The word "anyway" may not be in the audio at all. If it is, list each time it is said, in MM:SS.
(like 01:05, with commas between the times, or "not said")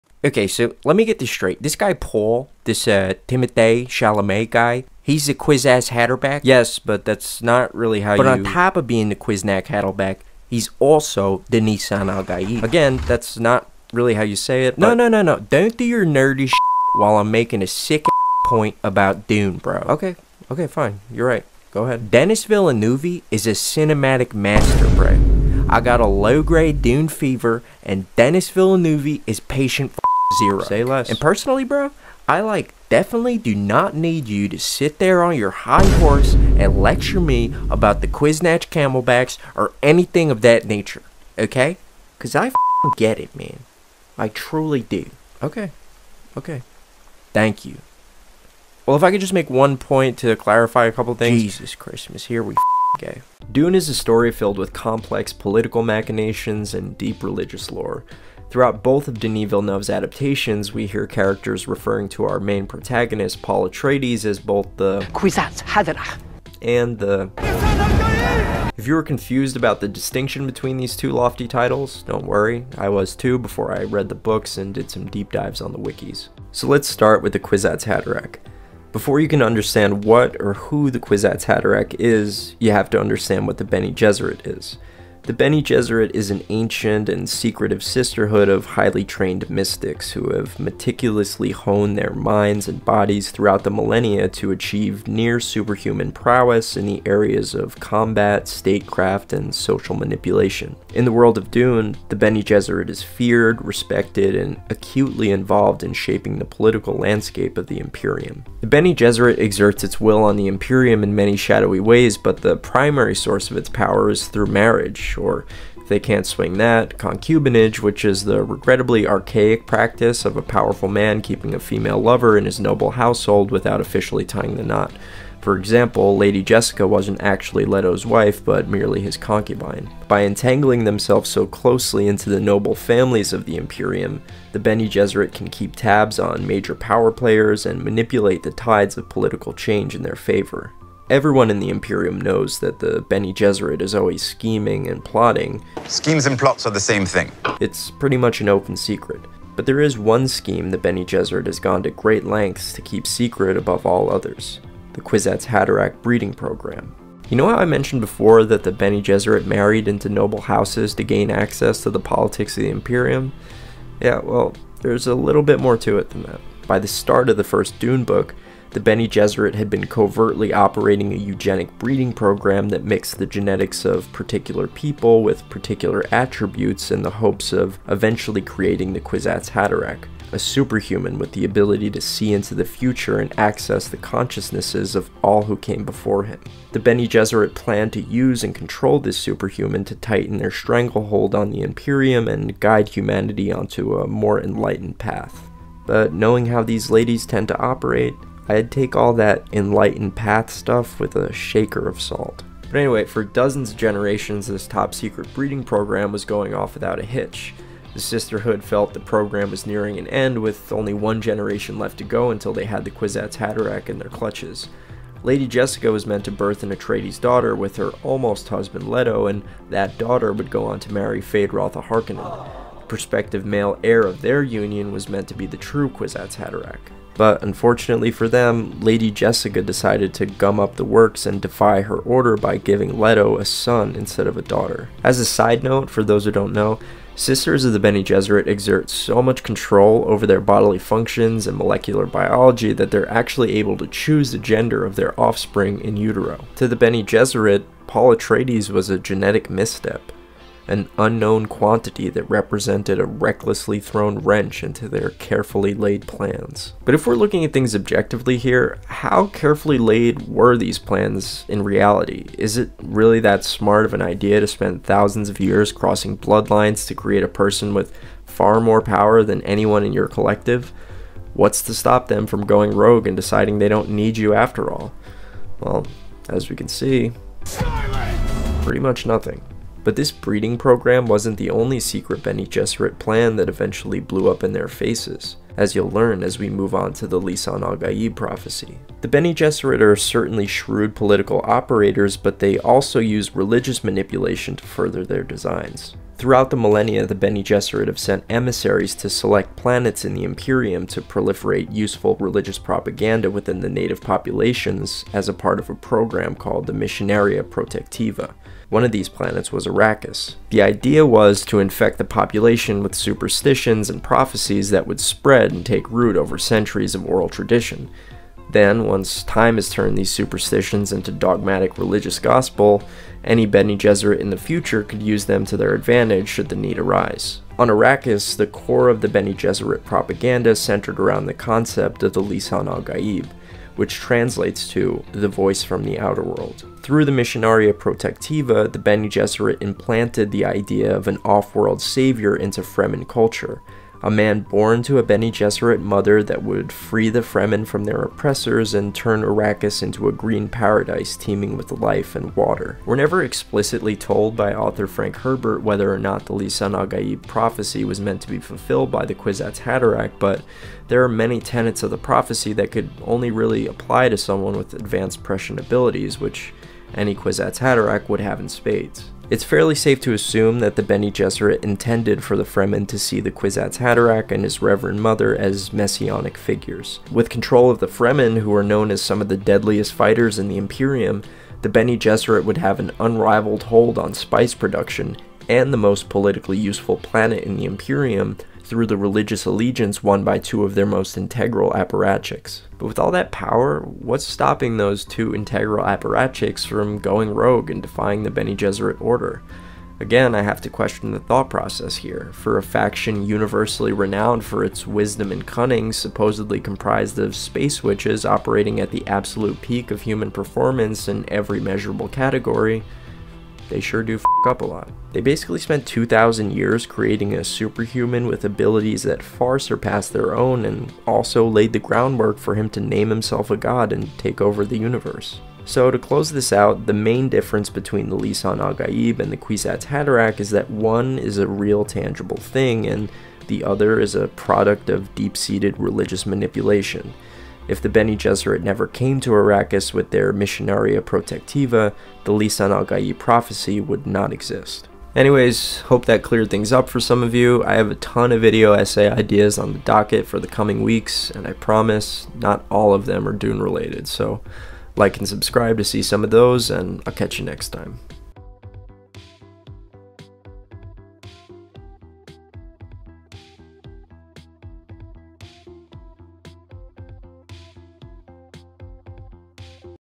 03:22, 07:25.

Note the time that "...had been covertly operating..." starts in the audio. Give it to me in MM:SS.
02:49.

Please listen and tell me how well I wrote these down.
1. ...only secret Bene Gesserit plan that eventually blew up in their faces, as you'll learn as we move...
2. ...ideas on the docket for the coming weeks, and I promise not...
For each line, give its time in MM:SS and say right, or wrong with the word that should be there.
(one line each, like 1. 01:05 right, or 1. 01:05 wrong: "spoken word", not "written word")
1. 04:41 right
2. 07:29 right.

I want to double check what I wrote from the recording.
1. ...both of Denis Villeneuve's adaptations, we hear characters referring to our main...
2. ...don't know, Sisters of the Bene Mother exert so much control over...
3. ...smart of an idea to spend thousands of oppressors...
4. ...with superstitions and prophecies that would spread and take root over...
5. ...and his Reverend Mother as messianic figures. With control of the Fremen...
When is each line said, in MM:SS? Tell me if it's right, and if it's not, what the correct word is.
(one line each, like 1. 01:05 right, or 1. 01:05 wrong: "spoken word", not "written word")
1. 00:58 right
2. 03:56 wrong: "Gesserit", not "Mother"
3. 04:23 wrong: "years", not "oppressors"
4. 05:12 right
5. 06:14 right.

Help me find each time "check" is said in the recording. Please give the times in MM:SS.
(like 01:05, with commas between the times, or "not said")
not said.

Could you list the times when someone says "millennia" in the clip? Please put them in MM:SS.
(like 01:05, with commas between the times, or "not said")
01:33, 04:56.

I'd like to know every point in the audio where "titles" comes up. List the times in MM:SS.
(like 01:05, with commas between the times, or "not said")
01:11.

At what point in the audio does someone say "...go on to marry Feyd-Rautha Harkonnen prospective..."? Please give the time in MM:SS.
03:40.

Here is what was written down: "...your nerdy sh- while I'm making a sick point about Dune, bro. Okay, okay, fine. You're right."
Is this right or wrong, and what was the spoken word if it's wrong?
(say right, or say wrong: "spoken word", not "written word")
right.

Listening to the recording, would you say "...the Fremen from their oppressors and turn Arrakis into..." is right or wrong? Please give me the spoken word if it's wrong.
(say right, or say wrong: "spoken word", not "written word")
right.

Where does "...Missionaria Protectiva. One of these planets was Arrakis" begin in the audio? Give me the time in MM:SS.
05:06.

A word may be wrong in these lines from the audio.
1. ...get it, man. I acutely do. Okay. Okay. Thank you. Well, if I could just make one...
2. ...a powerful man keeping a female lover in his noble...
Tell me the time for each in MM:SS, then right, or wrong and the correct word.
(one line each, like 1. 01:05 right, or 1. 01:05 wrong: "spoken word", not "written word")
1. 00:42 wrong: "truly", not "acutely"
2. 02:00 right.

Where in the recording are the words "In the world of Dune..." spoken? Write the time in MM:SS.
01:40.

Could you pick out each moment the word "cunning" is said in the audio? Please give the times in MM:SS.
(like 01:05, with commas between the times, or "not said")
06:45.